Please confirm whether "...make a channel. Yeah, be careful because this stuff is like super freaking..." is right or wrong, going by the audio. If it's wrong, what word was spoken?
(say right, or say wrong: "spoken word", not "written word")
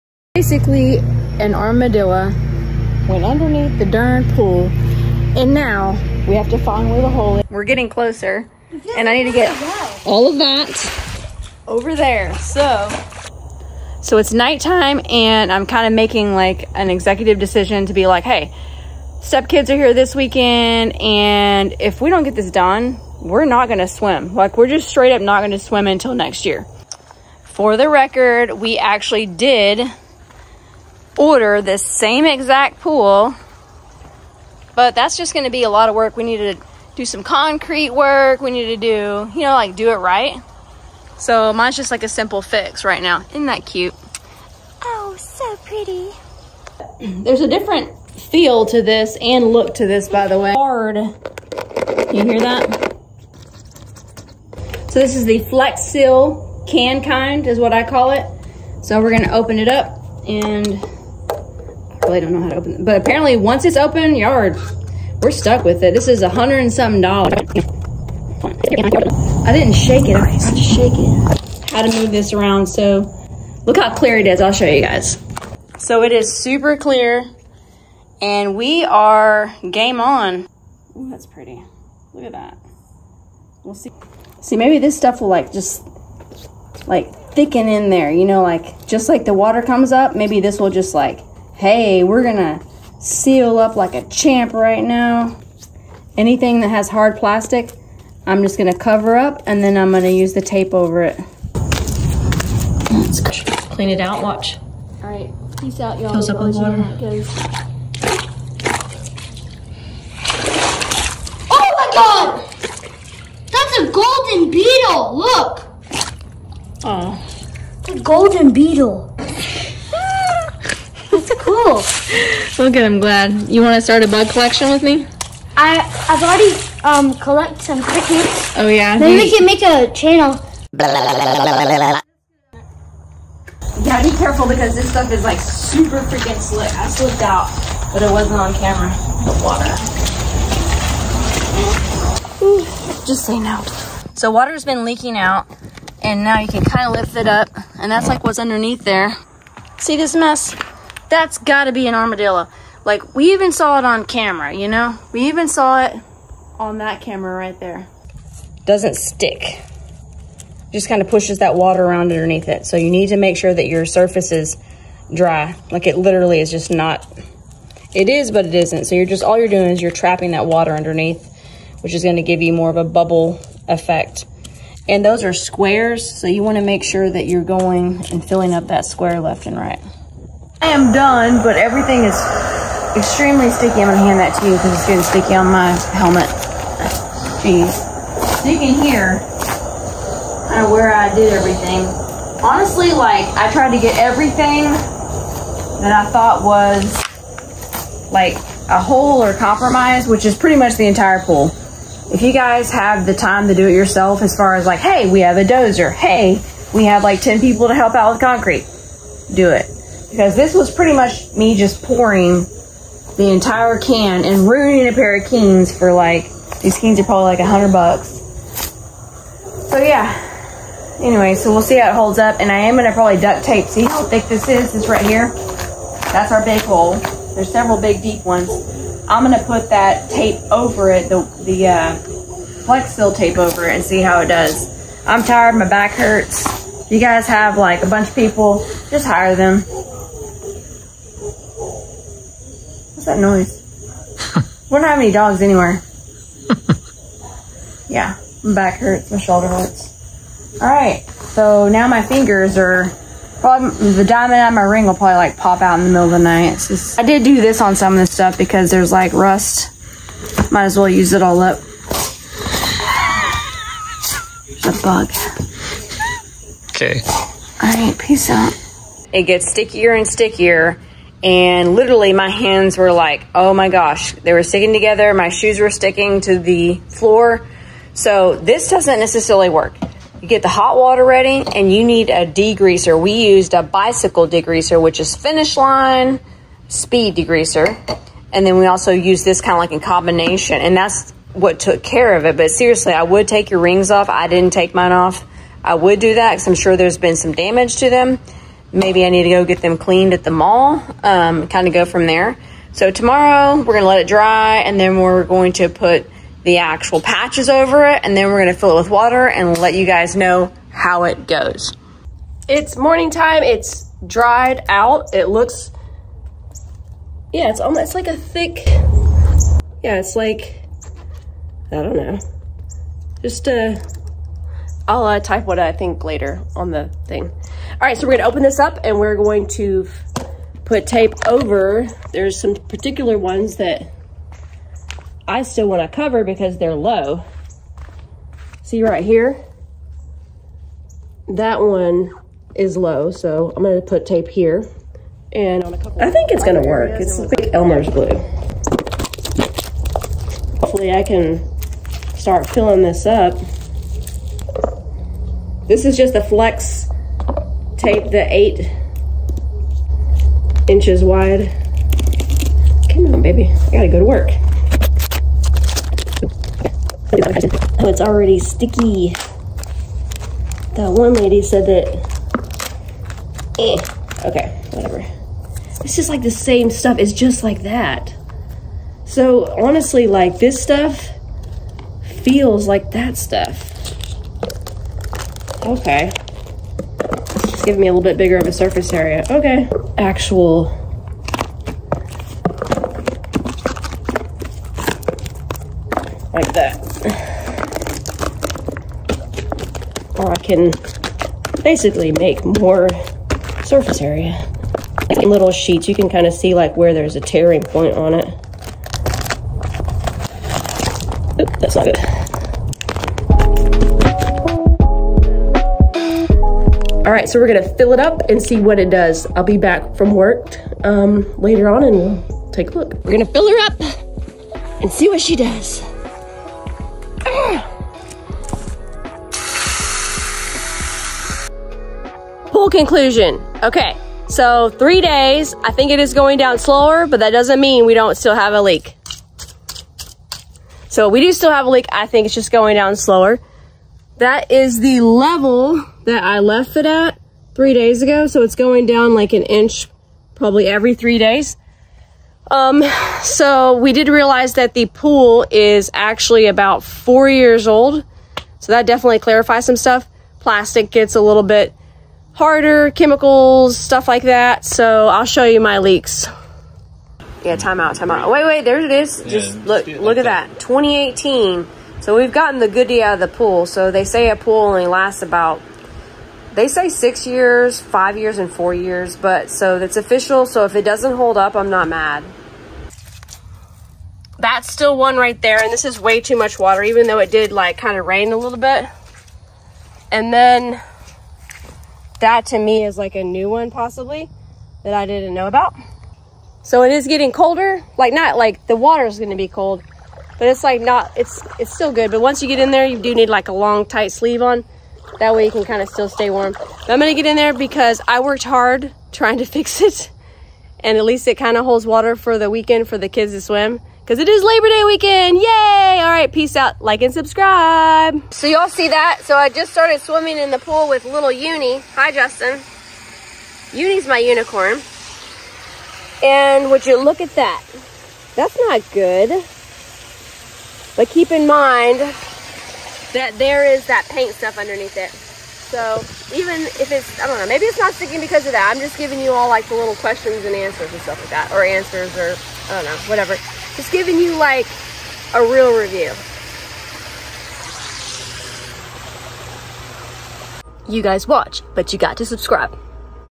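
right.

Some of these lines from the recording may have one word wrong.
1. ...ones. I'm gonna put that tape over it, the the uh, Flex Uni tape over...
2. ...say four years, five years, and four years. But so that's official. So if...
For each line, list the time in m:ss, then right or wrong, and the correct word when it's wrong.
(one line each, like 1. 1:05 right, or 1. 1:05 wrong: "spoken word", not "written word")
1. 3:48 wrong: "Seal", not "Uni"
2. 7:56 wrong: "six", not "four".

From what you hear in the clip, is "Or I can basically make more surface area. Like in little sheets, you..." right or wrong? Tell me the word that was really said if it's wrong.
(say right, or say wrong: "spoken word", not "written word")
right.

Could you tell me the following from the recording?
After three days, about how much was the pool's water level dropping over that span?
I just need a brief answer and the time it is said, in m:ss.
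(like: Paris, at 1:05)
An inch, at 7:29.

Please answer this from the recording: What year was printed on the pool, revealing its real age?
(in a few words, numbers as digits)
2018.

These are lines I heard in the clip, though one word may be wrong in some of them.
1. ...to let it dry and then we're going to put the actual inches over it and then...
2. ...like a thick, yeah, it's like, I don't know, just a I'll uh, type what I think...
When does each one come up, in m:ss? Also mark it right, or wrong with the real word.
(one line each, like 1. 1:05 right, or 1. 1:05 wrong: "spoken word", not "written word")
1. 5:03 wrong: "patches", not "inches"
2. 5:17 right.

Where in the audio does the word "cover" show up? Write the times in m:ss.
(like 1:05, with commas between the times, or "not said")
1:38, 5:35.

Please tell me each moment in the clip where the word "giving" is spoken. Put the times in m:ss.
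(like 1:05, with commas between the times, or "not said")
8:58, 9:03.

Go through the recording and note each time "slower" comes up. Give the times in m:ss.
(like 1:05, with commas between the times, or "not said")
7:16, 7:22.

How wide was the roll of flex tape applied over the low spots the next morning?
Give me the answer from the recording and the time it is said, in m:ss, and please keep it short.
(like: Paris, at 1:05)
8 inches, at 5:58.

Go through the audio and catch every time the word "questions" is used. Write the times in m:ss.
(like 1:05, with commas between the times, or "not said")
8:59.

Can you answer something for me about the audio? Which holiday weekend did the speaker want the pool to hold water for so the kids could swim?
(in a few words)
Labor Day.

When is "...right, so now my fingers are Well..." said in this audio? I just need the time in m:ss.
4:10.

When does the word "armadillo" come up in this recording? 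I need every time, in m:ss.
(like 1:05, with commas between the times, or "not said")
0:01, 2:31.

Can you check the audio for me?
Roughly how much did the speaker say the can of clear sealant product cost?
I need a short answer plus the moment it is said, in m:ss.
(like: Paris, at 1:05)
A hundred and something dollars, at 1:06.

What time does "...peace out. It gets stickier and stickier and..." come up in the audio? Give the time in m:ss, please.
4:27.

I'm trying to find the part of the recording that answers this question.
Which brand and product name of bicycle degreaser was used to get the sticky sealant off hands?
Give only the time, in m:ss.
4:45.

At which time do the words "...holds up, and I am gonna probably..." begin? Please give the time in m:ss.
3:41.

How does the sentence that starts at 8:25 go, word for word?
That way you can kind of still stay warm.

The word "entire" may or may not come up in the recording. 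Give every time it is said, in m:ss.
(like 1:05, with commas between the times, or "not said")
3:20, 3:33.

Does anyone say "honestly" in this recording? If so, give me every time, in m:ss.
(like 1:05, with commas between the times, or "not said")
3:12, 6:19.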